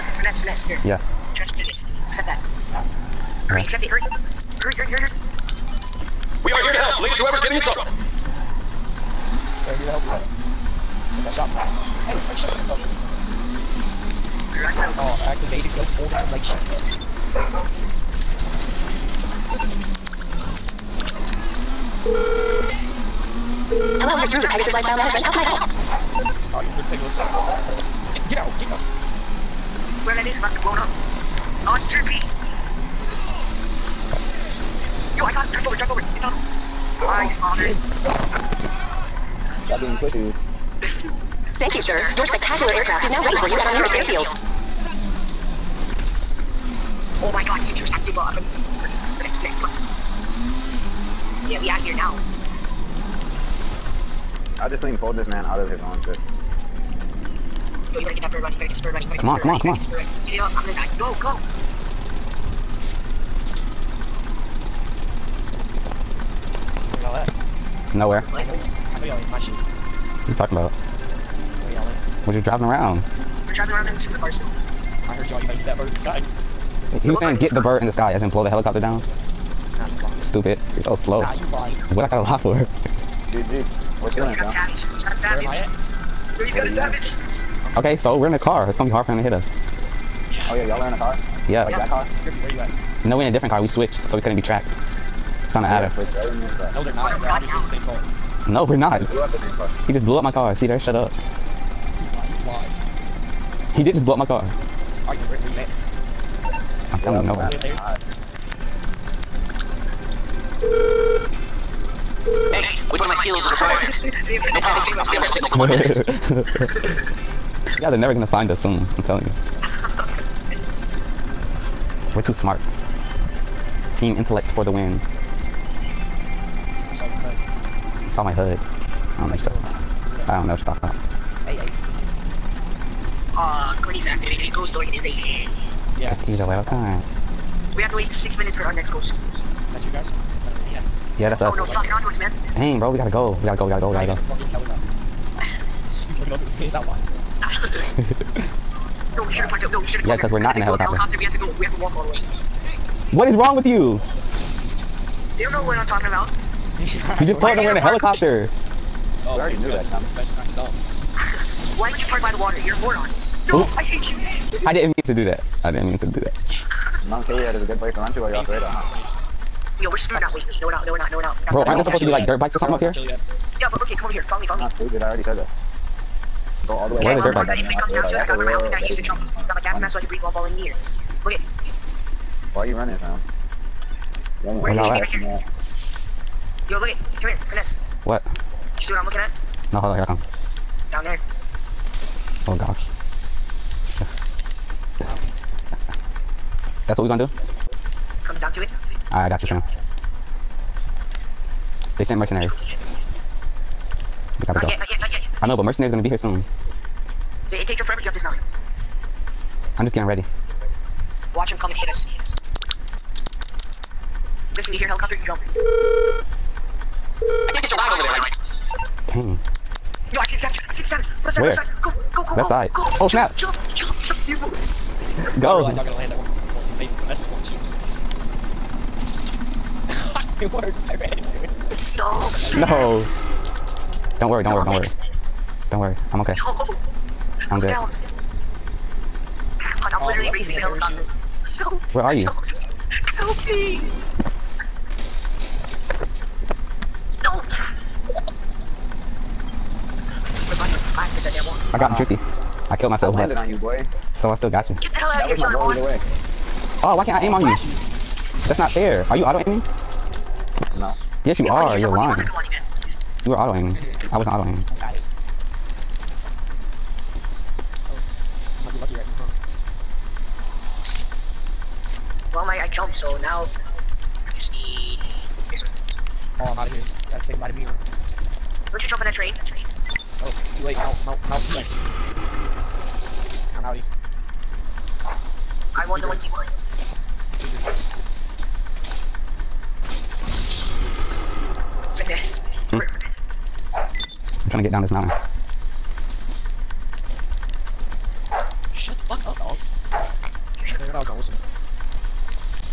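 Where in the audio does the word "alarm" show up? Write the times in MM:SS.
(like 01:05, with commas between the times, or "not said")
not said.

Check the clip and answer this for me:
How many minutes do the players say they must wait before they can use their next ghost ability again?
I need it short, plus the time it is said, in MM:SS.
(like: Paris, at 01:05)
6, at 02:18.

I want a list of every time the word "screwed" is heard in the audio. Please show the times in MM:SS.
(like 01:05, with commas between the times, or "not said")
02:49.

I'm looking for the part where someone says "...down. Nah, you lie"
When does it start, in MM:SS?
01:18.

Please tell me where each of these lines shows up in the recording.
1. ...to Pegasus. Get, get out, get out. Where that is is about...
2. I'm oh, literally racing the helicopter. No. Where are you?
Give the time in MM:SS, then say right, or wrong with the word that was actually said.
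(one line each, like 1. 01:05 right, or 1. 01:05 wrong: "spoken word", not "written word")
1. 00:26 right
2. 03:59 right.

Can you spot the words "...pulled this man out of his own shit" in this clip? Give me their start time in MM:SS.
00:54.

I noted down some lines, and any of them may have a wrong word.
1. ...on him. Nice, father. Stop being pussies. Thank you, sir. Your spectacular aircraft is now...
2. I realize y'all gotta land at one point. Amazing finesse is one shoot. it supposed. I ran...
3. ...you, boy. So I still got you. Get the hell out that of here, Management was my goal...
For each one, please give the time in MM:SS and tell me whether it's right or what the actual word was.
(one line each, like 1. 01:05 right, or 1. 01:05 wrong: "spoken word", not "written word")
1. 00:36 right
2. 03:45 wrong: "worked", not "supposed"
3. 04:13 wrong: "That", not "Management".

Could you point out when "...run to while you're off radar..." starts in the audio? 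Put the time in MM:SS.
02:47.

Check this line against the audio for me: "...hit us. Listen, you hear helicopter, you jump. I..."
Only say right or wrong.
right.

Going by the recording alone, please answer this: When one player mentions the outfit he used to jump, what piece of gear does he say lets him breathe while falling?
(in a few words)
Gas mask.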